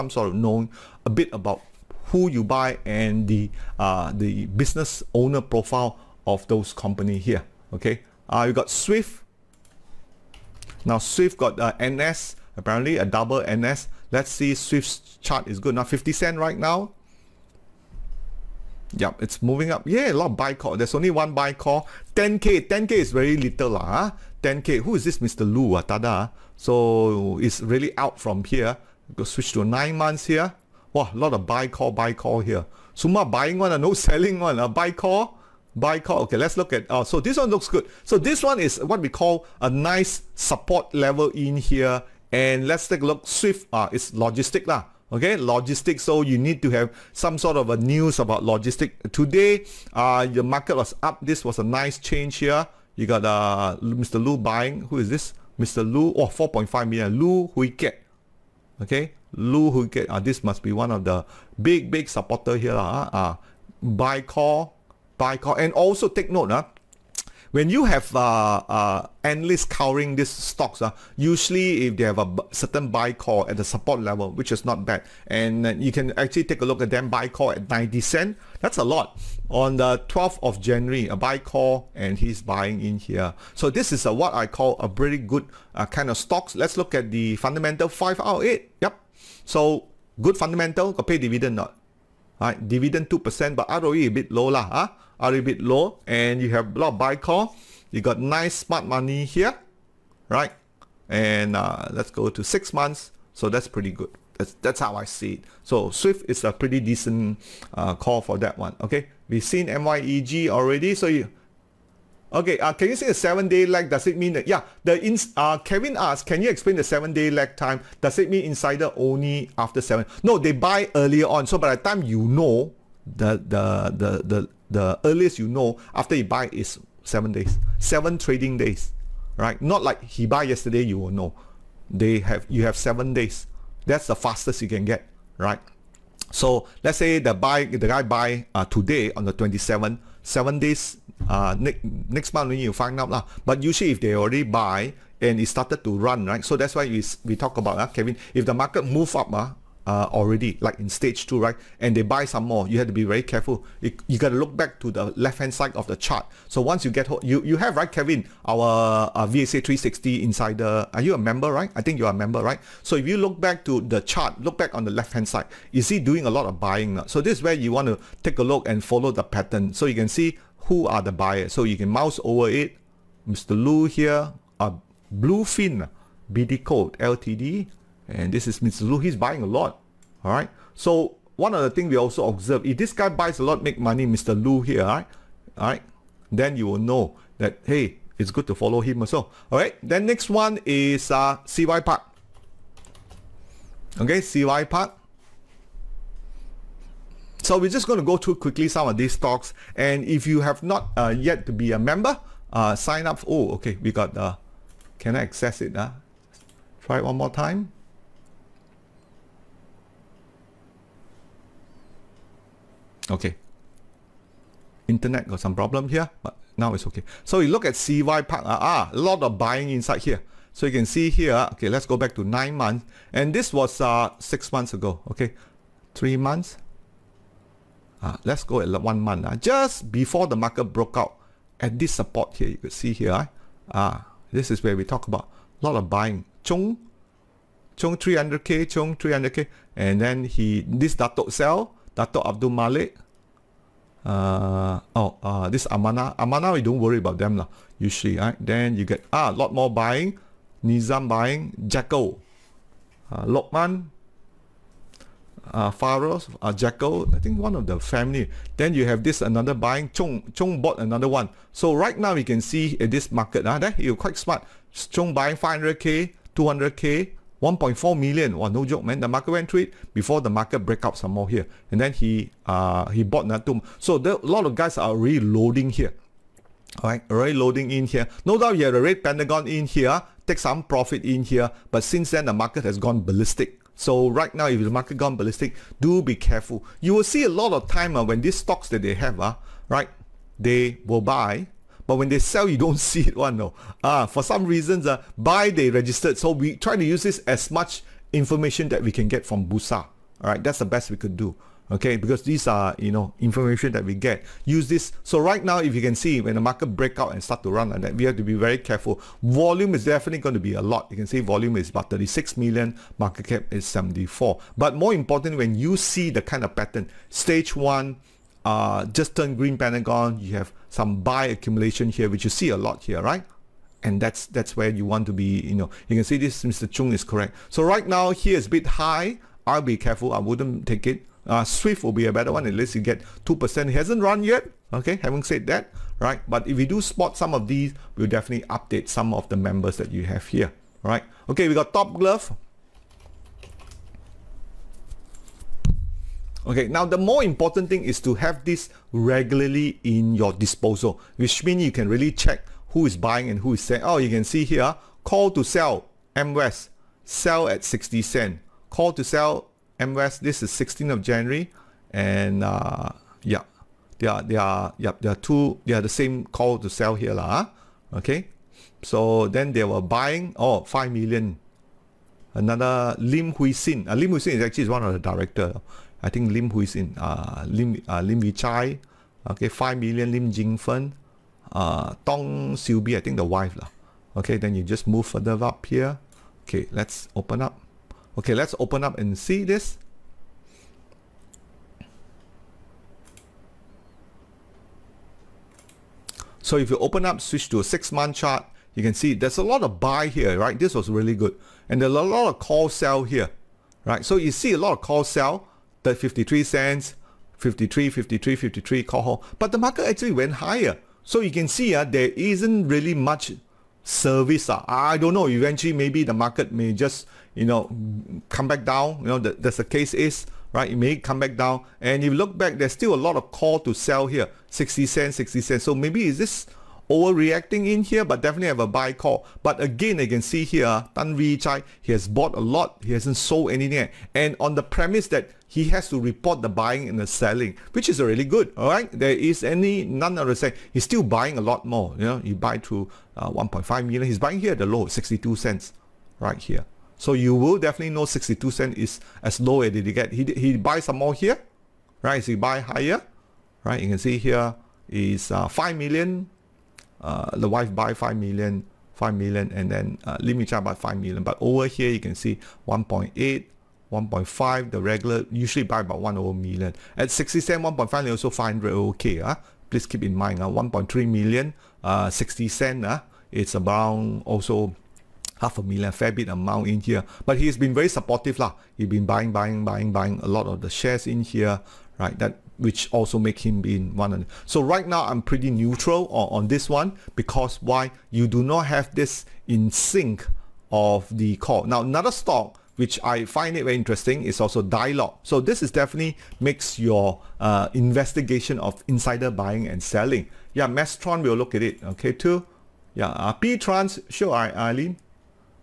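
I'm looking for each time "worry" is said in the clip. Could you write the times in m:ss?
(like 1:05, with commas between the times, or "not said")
4:06.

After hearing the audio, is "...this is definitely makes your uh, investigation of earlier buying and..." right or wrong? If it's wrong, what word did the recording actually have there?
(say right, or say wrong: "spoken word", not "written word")
wrong: "insider", not "earlier".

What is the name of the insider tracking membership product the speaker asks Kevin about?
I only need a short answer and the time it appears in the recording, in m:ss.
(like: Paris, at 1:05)
VSA 360 insider, at 2:39.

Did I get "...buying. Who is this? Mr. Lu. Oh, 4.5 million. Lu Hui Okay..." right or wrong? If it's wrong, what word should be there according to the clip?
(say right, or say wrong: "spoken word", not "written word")
right.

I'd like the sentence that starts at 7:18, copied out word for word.
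All right, there is any none of the same.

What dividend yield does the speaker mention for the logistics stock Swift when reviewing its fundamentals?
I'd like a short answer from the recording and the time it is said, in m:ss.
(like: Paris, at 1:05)
2%, at 1:32.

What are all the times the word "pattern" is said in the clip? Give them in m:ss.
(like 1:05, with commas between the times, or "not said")
2:49, 5:16.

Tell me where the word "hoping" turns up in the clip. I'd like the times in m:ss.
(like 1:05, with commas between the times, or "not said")
not said.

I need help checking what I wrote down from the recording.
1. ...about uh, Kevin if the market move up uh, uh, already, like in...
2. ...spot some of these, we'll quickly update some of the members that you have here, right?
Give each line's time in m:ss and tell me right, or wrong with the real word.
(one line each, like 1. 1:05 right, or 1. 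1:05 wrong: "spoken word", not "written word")
1. 2:27 right
2. 5:36 wrong: "definitely", not "quickly".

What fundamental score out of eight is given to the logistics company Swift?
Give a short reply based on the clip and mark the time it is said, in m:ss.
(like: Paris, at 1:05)
5 out of 8, at 1:27.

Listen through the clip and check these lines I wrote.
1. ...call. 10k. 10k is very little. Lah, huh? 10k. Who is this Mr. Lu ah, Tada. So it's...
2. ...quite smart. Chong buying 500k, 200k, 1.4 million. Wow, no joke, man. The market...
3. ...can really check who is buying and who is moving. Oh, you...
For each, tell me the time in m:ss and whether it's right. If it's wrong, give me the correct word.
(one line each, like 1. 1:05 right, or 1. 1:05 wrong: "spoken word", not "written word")
1. 0:21 right
2. 4:23 right
3. 5:51 wrong: "selling", not "moving".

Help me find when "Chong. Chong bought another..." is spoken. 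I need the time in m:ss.
4:19.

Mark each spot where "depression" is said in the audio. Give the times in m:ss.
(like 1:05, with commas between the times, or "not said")
not said.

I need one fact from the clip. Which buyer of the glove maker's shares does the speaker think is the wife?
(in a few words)
Tong Siew Bee.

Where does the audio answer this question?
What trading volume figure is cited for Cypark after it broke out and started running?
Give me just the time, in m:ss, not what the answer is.
5:11.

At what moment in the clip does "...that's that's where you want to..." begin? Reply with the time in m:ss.
5:23.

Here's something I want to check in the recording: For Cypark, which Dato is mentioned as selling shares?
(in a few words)
Dato Abdul Malik.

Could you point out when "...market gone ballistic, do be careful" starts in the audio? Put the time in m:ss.
4:44.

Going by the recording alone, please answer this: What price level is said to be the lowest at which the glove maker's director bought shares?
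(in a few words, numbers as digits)
62 cents.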